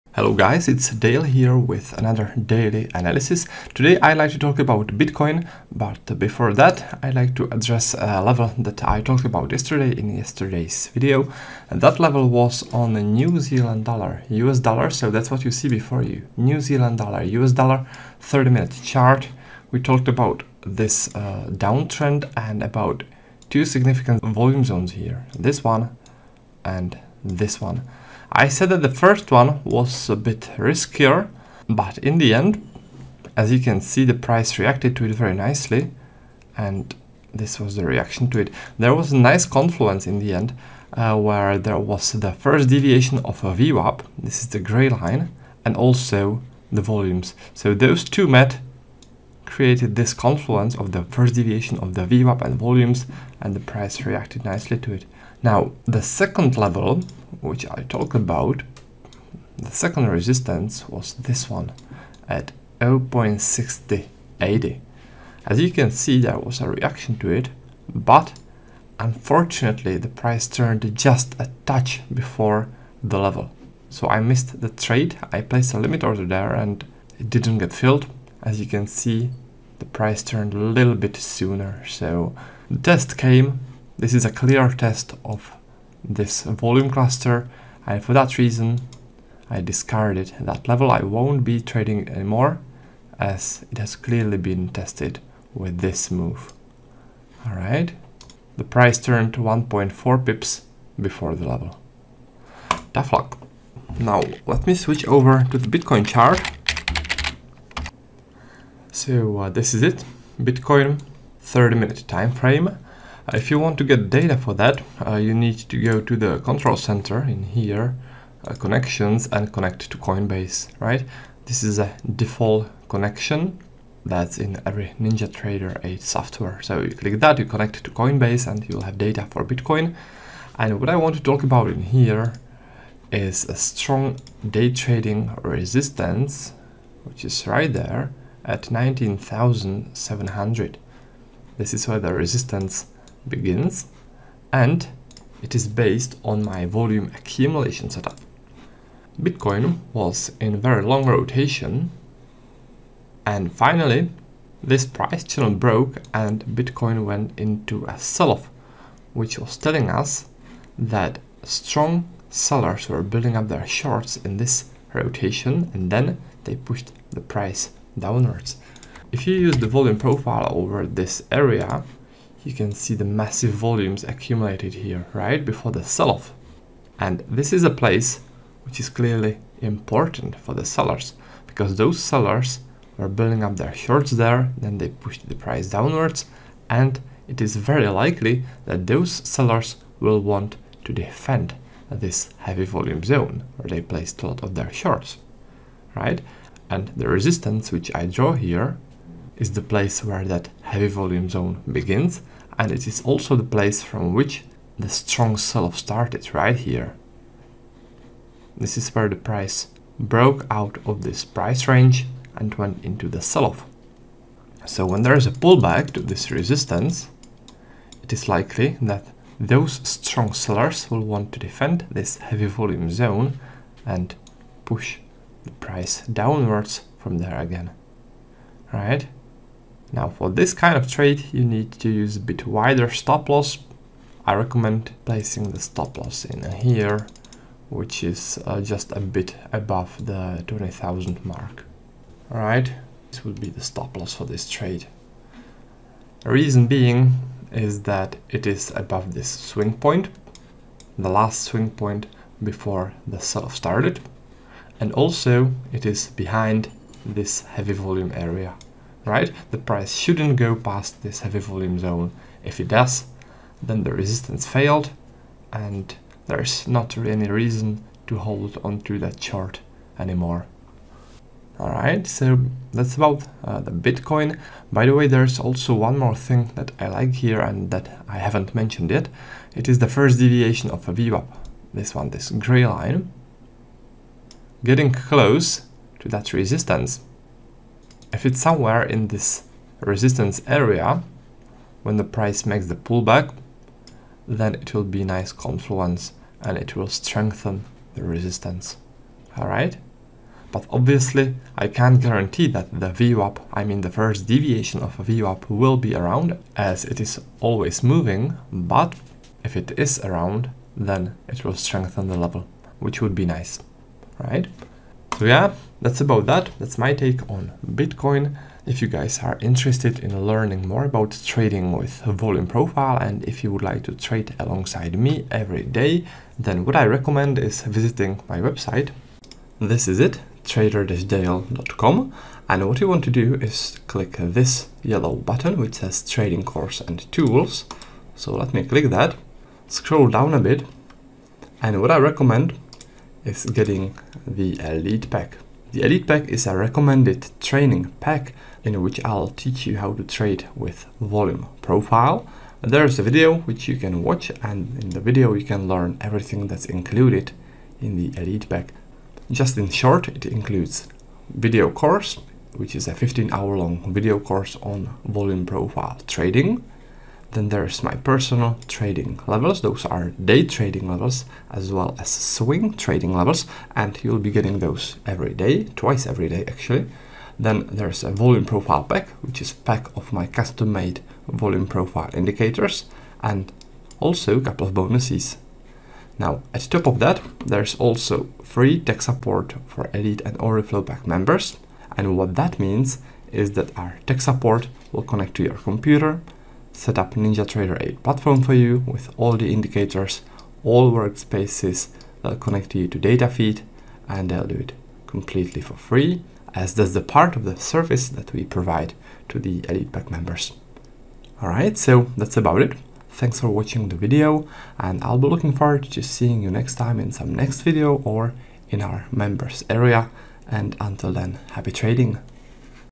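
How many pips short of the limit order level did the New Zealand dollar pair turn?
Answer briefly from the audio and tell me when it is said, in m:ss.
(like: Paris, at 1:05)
1.4, at 1:39.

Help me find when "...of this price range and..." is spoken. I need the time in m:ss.
3:30.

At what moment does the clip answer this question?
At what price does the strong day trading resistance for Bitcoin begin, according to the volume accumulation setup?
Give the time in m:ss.
2:18.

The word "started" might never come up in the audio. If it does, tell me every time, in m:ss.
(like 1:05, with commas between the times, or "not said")
3:25, 4:13.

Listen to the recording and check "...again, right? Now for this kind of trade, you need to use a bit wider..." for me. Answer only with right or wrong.
right.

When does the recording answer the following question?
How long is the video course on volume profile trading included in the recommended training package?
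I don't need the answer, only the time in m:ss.
6:02.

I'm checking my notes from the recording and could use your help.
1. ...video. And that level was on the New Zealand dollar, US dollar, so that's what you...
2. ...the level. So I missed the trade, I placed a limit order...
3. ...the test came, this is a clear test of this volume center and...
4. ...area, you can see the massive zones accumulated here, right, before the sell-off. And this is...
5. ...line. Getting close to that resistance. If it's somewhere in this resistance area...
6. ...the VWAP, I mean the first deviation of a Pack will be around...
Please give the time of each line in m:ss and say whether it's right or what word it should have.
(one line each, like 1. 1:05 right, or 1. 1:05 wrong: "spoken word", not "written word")
1. 0:10 right
2. 1:13 right
3. 1:22 wrong: "cluster", not "center"
4. 2:51 wrong: "volumes", not "zones"
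5. 4:42 right
6. 5:02 wrong: "VWAP", not "Pack".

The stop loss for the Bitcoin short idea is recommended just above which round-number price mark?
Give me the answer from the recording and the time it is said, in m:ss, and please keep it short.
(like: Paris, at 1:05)
20,000, at 4:00.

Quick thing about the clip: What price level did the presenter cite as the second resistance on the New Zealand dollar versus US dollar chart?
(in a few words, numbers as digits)
0.6080.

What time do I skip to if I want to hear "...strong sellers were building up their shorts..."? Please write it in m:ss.
2:41.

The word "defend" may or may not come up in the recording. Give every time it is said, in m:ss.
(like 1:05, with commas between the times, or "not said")
3:10, 3:41.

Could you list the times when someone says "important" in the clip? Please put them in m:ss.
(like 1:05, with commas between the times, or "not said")
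2:59.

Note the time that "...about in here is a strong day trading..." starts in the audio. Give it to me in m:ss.
2:11.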